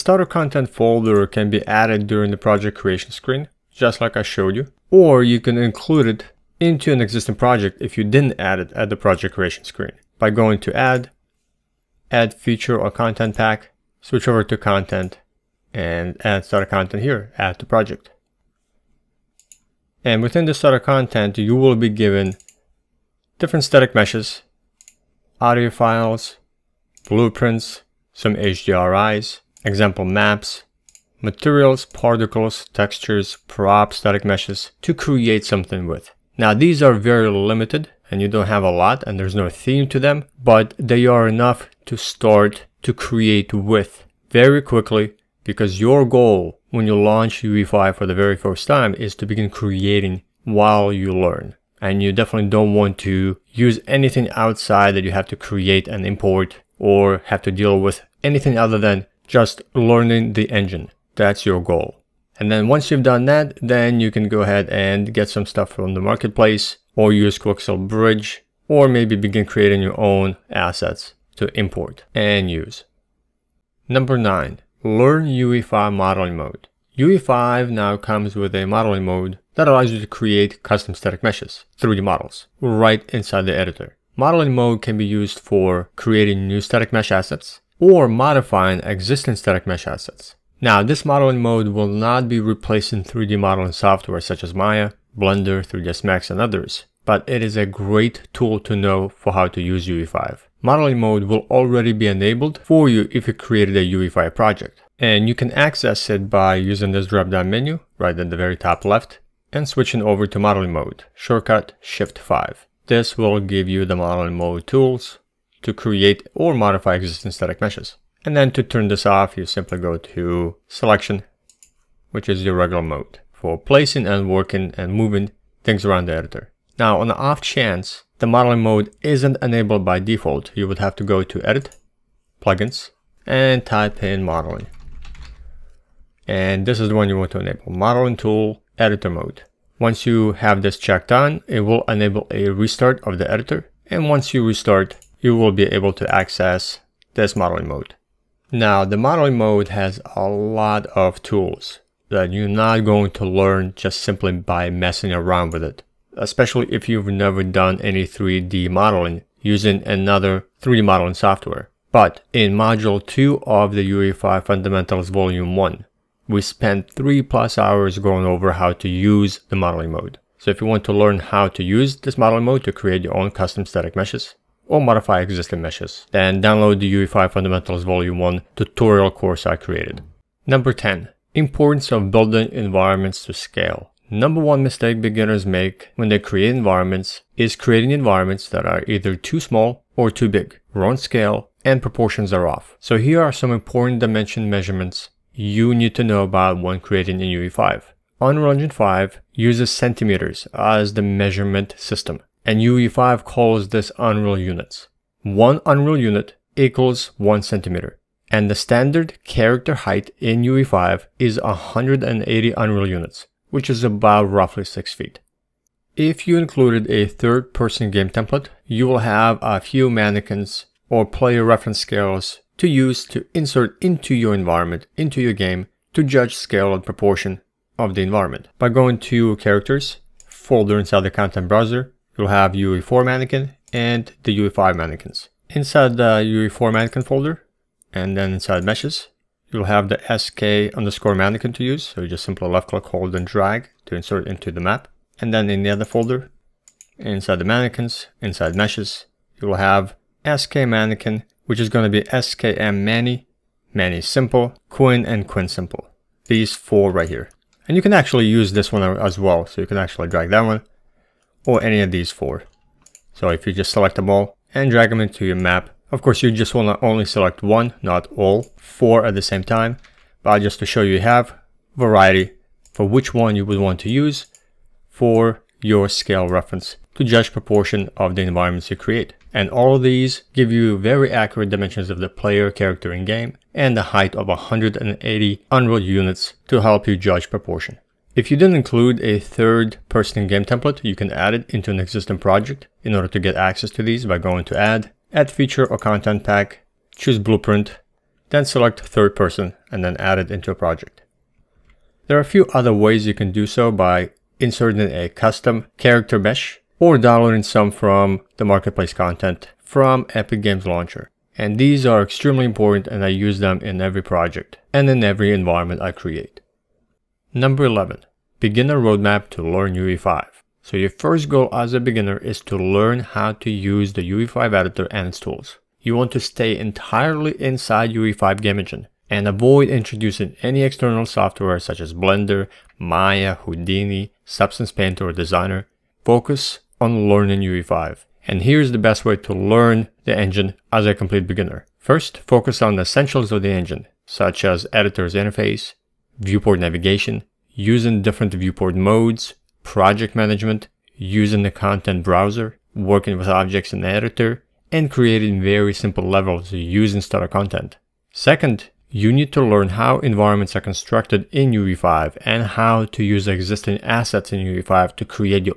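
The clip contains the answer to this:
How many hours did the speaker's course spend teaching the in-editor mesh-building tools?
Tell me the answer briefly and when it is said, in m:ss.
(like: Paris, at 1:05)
3 plus hours, at 2:46.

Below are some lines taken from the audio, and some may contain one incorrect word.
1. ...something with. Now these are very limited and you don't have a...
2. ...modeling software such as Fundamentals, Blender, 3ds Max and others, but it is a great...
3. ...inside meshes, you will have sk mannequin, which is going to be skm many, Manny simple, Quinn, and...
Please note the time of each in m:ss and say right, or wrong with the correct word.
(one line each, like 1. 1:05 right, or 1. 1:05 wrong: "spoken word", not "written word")
1. 0:35 right
2. 1:33 wrong: "Maya", not "Fundamentals"
3. 4:08 right.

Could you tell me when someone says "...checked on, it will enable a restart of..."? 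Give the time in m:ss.
2:20.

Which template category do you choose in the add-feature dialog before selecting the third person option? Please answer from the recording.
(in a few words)
Blueprint.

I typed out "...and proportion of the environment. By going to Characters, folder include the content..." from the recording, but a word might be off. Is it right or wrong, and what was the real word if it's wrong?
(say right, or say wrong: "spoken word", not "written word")
wrong: "inside", not "include".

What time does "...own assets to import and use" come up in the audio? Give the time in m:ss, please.
1:09.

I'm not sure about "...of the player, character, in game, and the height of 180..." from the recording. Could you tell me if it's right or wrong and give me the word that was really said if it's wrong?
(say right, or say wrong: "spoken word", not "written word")
right.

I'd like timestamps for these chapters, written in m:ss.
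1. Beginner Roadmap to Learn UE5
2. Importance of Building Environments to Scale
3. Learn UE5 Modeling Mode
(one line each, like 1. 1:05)
1. 5:16
2. 2:59
3. 1:13.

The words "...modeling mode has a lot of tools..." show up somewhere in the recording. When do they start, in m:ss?
2:29.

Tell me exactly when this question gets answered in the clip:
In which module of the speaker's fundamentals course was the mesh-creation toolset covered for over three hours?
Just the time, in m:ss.
2:42.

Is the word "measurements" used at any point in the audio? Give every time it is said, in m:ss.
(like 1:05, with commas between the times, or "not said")
3:14, 3:21.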